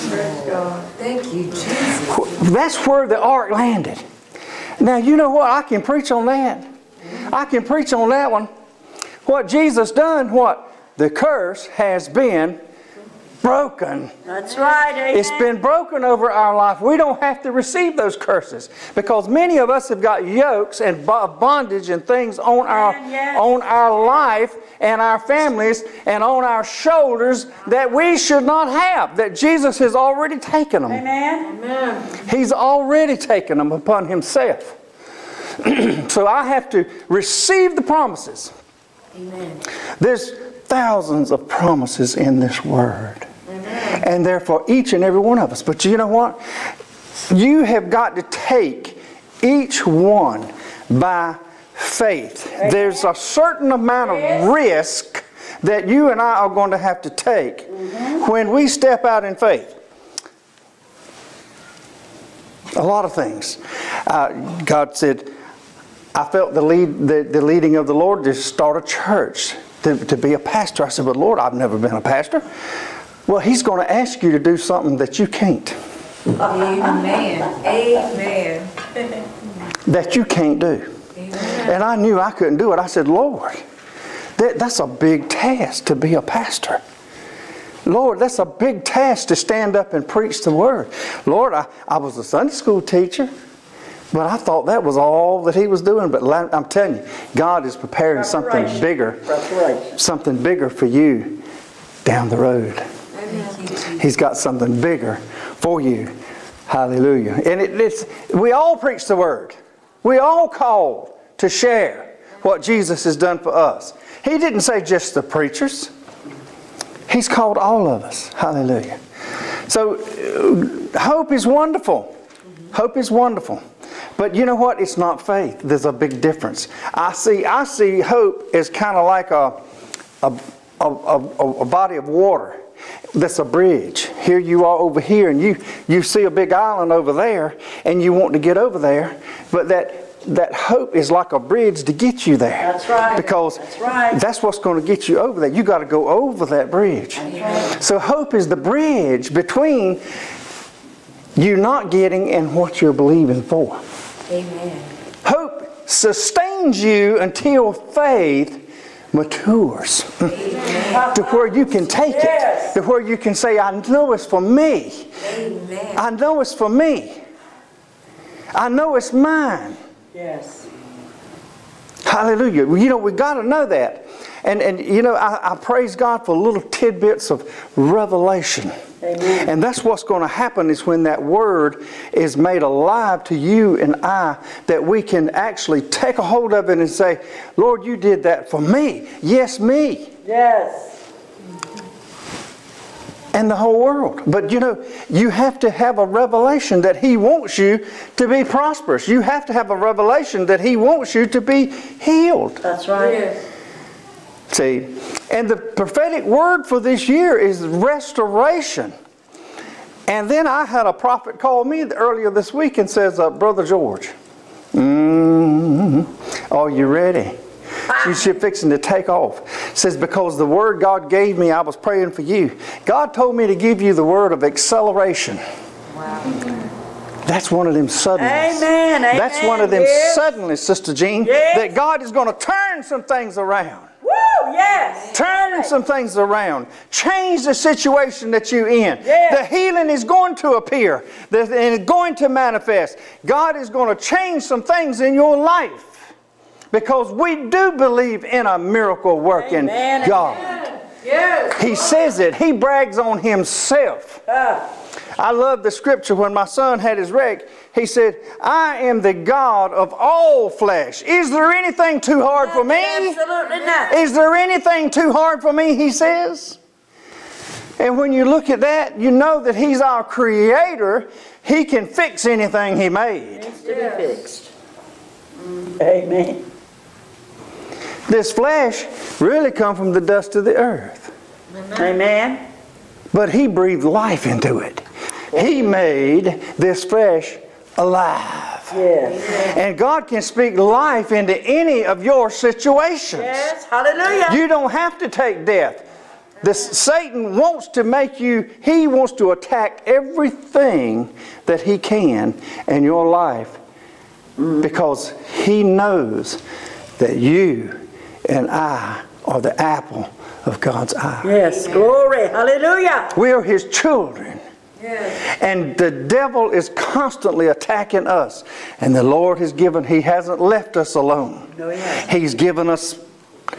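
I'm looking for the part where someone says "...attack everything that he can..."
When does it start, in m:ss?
4:59.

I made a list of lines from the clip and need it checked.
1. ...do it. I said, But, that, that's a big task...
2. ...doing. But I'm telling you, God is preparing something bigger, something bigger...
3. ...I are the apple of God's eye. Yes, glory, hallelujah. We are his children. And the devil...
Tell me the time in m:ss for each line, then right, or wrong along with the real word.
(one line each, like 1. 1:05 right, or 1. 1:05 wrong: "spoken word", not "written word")
1. 1:22 wrong: "Lord", not "But"
2. 1:35 right
3. 5:08 right.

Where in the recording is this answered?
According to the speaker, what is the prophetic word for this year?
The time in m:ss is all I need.
3:27.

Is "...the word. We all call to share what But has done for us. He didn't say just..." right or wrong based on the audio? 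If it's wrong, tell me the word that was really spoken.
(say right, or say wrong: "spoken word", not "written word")
wrong: "Jesus", not "But".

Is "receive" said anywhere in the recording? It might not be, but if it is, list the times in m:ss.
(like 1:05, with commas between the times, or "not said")
0:17, 0:37.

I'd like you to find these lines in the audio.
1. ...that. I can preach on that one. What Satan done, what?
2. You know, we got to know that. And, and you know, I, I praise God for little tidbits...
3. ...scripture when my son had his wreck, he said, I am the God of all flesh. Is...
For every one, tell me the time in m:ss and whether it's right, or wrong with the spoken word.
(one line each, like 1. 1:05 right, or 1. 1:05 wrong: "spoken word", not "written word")
1. 0:06 wrong: "Jesus", not "Satan"
2. 2:52 right
3. 4:15 right.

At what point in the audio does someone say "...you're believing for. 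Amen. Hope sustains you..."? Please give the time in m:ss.
2:32.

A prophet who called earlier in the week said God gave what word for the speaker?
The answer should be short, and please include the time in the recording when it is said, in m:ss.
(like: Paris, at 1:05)
Acceleration, at 3:44.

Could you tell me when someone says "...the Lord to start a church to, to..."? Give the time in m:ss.
1:07.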